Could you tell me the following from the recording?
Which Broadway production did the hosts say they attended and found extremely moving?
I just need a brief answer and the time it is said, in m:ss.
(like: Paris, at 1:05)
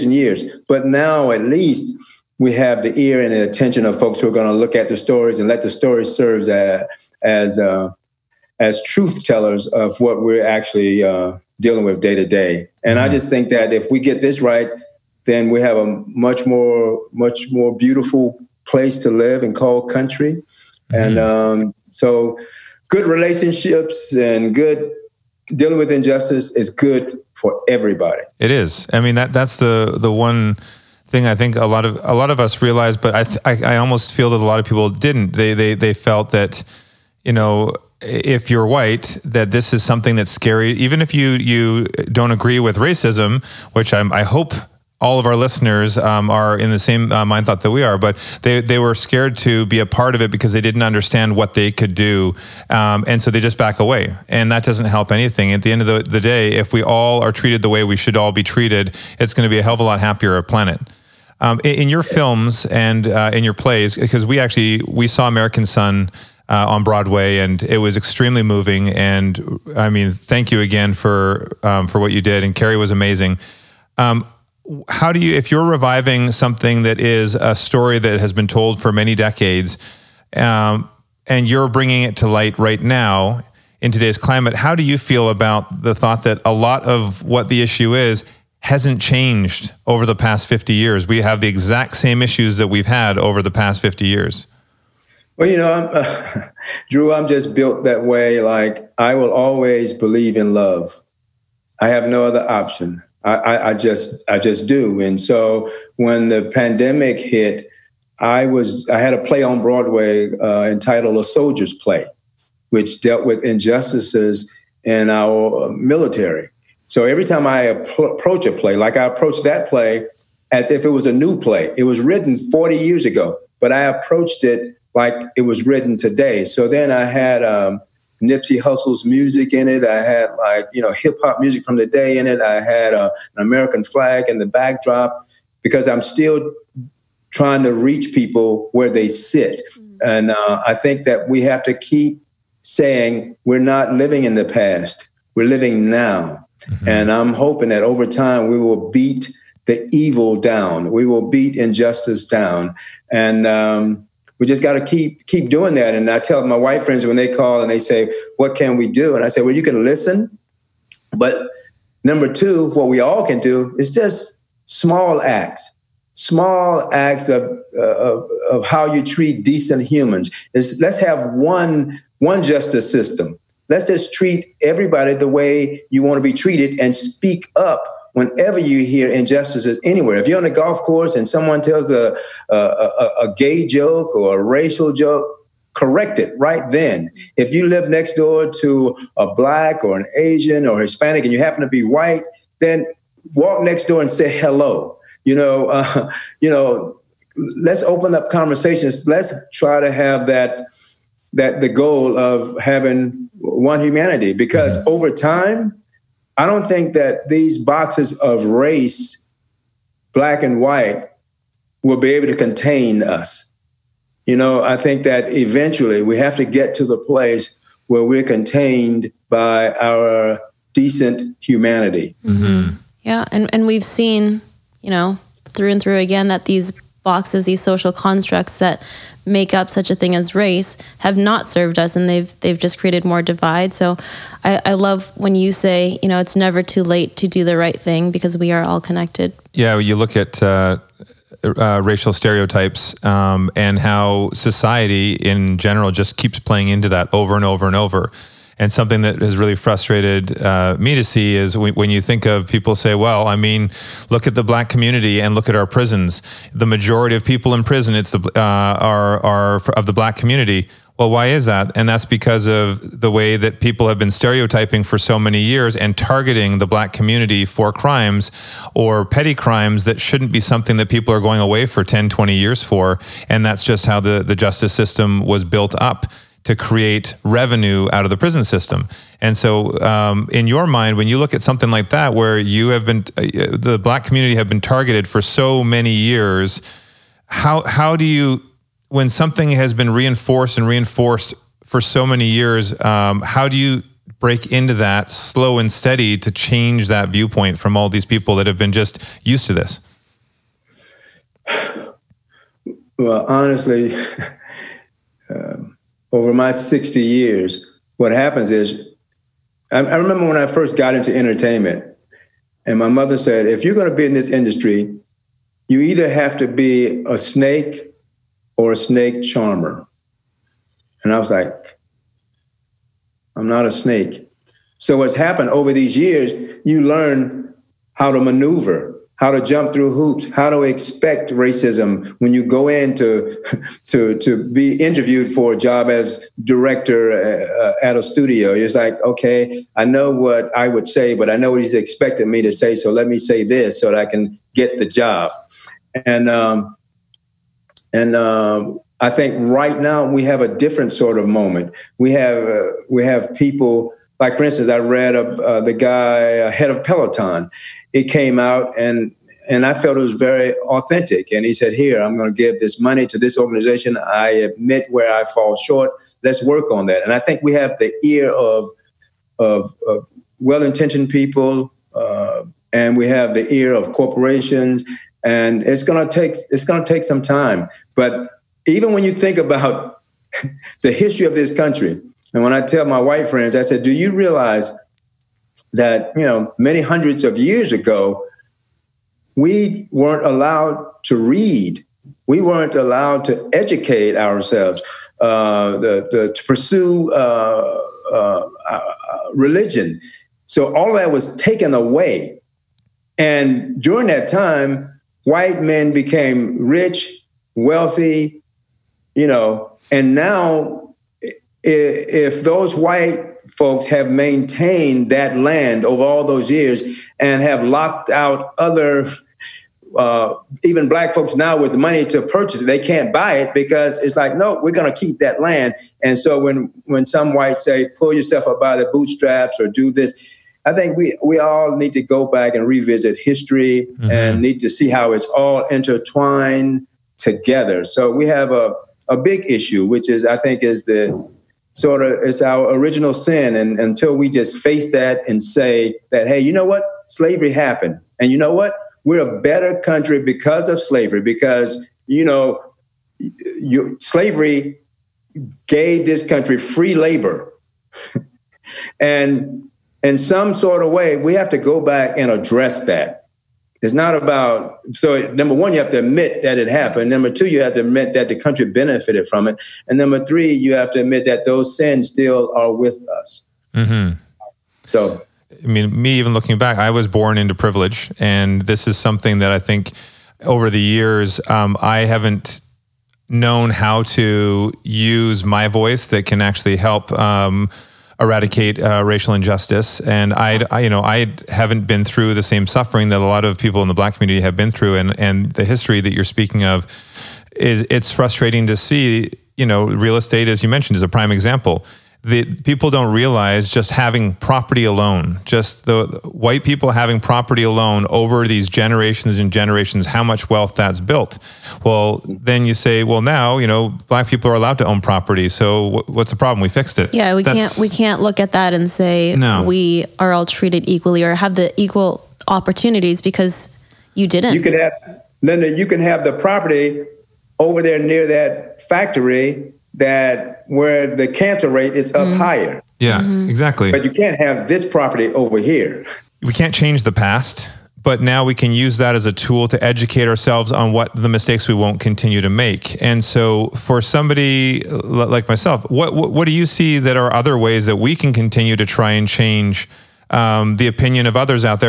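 American Son, at 1:05.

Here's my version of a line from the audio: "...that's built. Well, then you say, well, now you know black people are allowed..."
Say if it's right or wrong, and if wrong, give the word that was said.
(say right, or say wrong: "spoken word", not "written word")
right.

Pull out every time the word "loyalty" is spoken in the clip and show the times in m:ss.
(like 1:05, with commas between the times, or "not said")
not said.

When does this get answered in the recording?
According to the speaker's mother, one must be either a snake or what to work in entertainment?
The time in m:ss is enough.
5:18.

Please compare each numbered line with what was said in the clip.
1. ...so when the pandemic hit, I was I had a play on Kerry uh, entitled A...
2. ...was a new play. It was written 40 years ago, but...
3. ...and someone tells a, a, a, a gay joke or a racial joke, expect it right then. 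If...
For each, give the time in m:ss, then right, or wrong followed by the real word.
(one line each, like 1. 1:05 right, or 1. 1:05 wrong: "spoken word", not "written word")
1. 1:45 wrong: "Broadway", not "Kerry"
2. 2:00 right
3. 3:01 wrong: "correct", not "expect".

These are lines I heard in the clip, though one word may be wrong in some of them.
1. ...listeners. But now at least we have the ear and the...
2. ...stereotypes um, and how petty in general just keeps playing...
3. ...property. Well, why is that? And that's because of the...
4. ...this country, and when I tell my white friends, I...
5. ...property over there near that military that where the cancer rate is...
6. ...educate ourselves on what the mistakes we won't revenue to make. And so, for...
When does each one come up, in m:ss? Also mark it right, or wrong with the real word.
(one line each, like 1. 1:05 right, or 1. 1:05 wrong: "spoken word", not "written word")
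1. 0:00 wrong: "years", not "listeners"
2. 4:02 wrong: "society", not "petty"
3. 4:20 wrong: "community", not "property"
4. 6:21 right
5. 8:46 wrong: "factory", not "military"
6. 8:59 wrong: "continue", not "revenue".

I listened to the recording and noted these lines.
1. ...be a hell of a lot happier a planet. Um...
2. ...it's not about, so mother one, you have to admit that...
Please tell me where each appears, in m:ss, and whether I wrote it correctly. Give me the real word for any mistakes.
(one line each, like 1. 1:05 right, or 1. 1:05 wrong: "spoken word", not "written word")
1. 0:59 right
2. 7:43 wrong: "number", not "mother".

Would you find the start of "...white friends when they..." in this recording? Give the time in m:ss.
2:36.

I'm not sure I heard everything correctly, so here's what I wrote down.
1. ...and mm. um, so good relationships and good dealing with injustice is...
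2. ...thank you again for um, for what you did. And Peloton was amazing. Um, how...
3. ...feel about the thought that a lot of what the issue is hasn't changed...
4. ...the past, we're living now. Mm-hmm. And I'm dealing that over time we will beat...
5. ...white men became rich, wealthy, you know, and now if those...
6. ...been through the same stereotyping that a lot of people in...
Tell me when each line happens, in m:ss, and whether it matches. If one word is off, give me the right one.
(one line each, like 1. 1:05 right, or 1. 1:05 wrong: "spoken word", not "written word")
1. 0:20 right
2. 1:10 wrong: "Kerry", not "Peloton"
3. 1:24 right
4. 2:24 wrong: "hoping", not "dealing"
5. 6:45 right
6. 8:11 wrong: "suffering", not "stereotyping".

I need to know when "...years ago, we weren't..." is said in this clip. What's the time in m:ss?
6:27.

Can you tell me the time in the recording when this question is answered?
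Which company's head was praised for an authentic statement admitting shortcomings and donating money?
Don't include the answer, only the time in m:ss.
5:56.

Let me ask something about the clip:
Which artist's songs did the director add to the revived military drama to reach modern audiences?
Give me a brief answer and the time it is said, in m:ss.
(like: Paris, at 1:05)
Nipsey Hussle, at 2:08.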